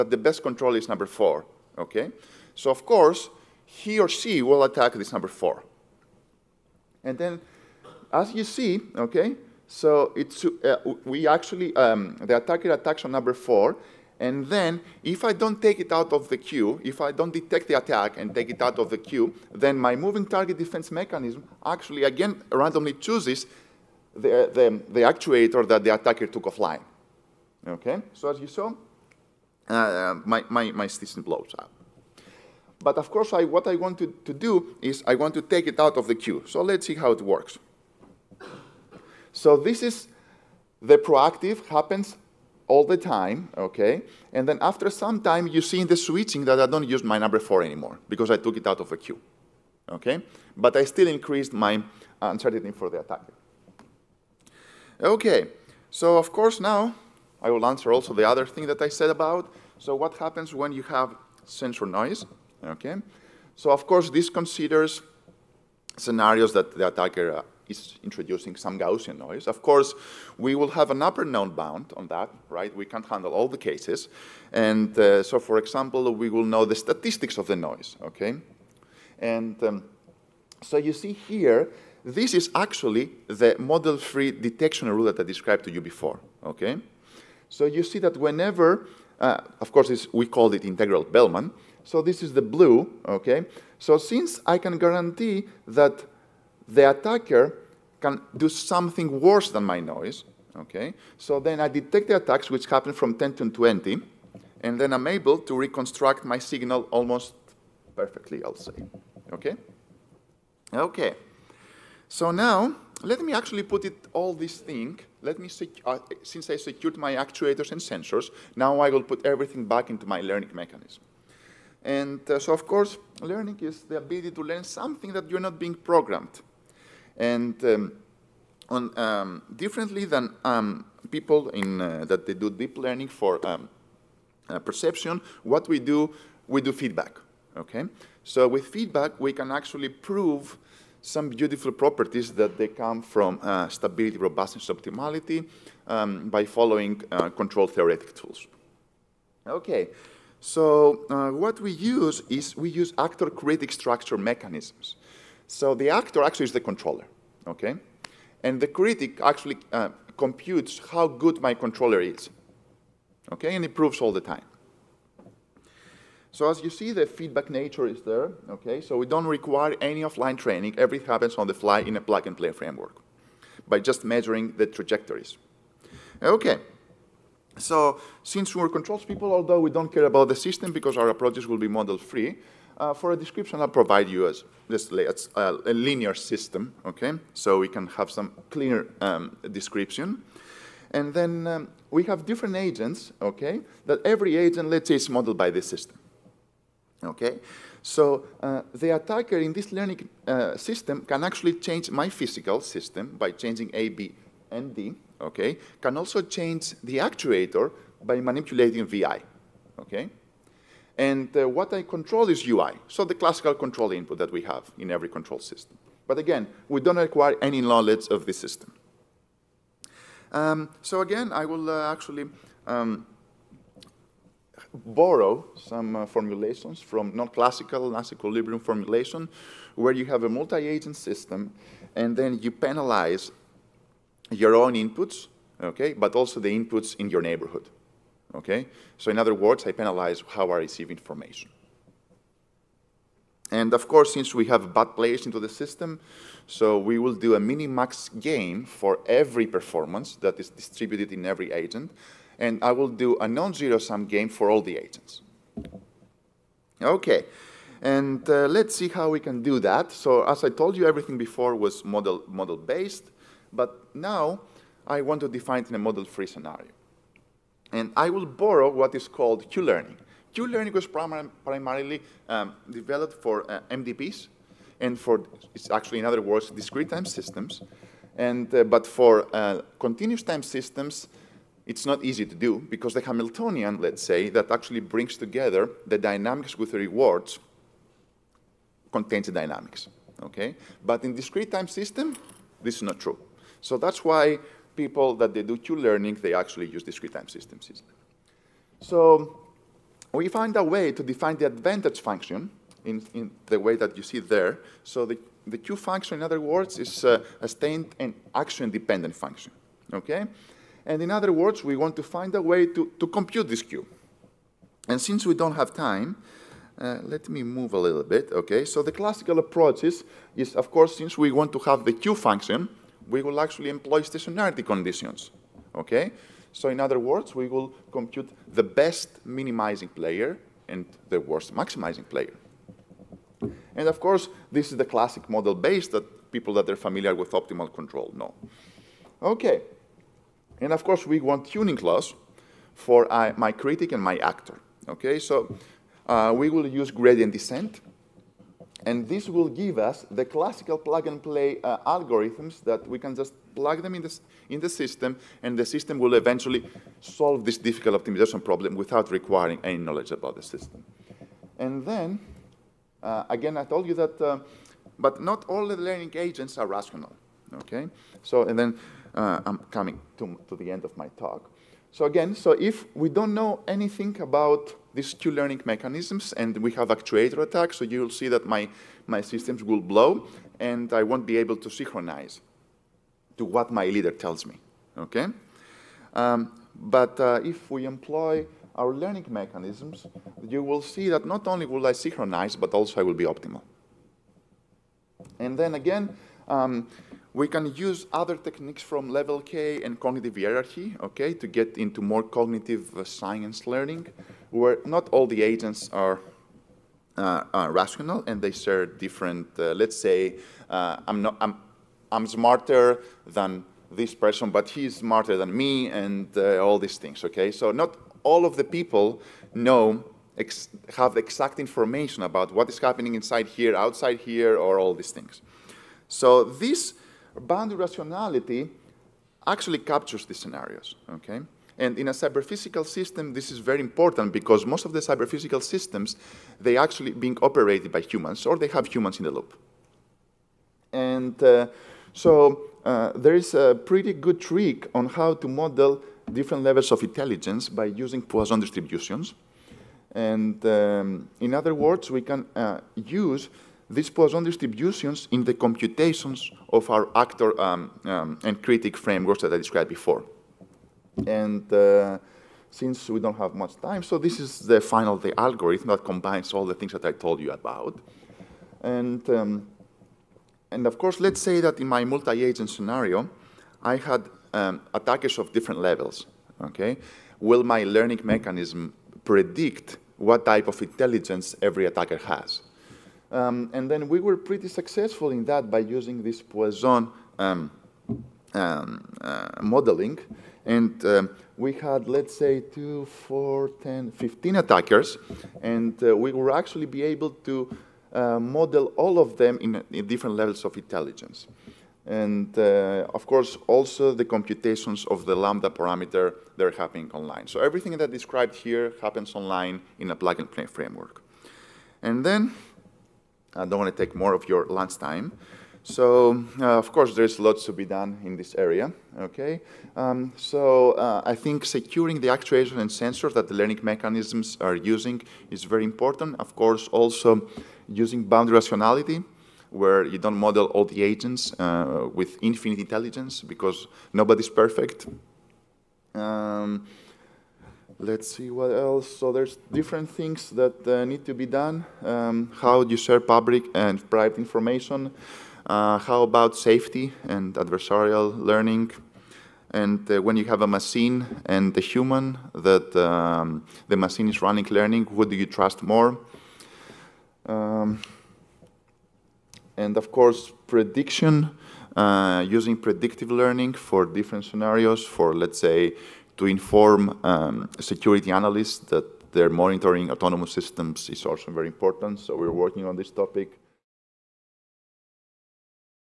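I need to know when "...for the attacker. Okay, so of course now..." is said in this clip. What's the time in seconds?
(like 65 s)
52 s.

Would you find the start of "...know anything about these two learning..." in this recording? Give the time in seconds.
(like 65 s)
373 s.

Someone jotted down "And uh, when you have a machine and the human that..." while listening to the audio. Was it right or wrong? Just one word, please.
right.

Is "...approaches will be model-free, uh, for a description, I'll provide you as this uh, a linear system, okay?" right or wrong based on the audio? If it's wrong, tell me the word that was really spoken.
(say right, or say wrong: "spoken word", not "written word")
right.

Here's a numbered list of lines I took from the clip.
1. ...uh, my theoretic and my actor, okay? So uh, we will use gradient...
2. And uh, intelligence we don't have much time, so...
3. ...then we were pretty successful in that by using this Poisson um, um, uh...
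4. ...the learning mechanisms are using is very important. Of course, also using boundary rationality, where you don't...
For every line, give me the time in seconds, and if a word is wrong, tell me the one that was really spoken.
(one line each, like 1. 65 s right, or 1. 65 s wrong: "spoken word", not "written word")
1. 343 s wrong: "critic", not "theoretic"
2. 461 s wrong: "since", not "intelligence"
3. 483 s right
4. 523 s right.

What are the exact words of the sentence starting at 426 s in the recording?
So this boundary rationality actually captures these scenarios, okay?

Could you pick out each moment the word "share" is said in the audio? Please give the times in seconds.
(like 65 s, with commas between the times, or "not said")
408 s, 542 s.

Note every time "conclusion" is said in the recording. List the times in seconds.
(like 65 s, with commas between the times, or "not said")
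not said.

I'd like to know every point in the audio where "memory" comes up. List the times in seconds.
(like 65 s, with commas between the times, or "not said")
not said.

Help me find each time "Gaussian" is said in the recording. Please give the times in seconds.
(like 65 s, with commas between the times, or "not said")
68 s.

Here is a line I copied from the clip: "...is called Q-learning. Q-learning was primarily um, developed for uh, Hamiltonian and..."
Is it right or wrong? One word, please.
wrong.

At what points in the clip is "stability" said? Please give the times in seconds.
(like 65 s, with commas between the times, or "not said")
143 s.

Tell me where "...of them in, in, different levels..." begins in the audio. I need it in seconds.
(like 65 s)
499 s.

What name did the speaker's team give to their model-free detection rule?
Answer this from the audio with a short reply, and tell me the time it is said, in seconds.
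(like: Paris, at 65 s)
integral Bellman, at 90 s.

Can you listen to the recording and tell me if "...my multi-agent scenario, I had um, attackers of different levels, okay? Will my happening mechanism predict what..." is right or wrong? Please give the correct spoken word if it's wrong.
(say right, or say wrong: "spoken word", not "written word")
wrong: "learning", not "happening".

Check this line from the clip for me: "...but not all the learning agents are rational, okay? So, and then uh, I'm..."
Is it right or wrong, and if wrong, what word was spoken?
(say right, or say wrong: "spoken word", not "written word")
right.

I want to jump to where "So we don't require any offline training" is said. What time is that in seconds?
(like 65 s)
168 s.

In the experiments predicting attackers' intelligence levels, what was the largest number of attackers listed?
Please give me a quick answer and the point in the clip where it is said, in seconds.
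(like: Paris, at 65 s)
15, at 494 s.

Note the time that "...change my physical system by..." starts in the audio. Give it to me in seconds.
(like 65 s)
201 s.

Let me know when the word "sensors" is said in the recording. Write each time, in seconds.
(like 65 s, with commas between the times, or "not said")
61 s, 117 s, 522 s.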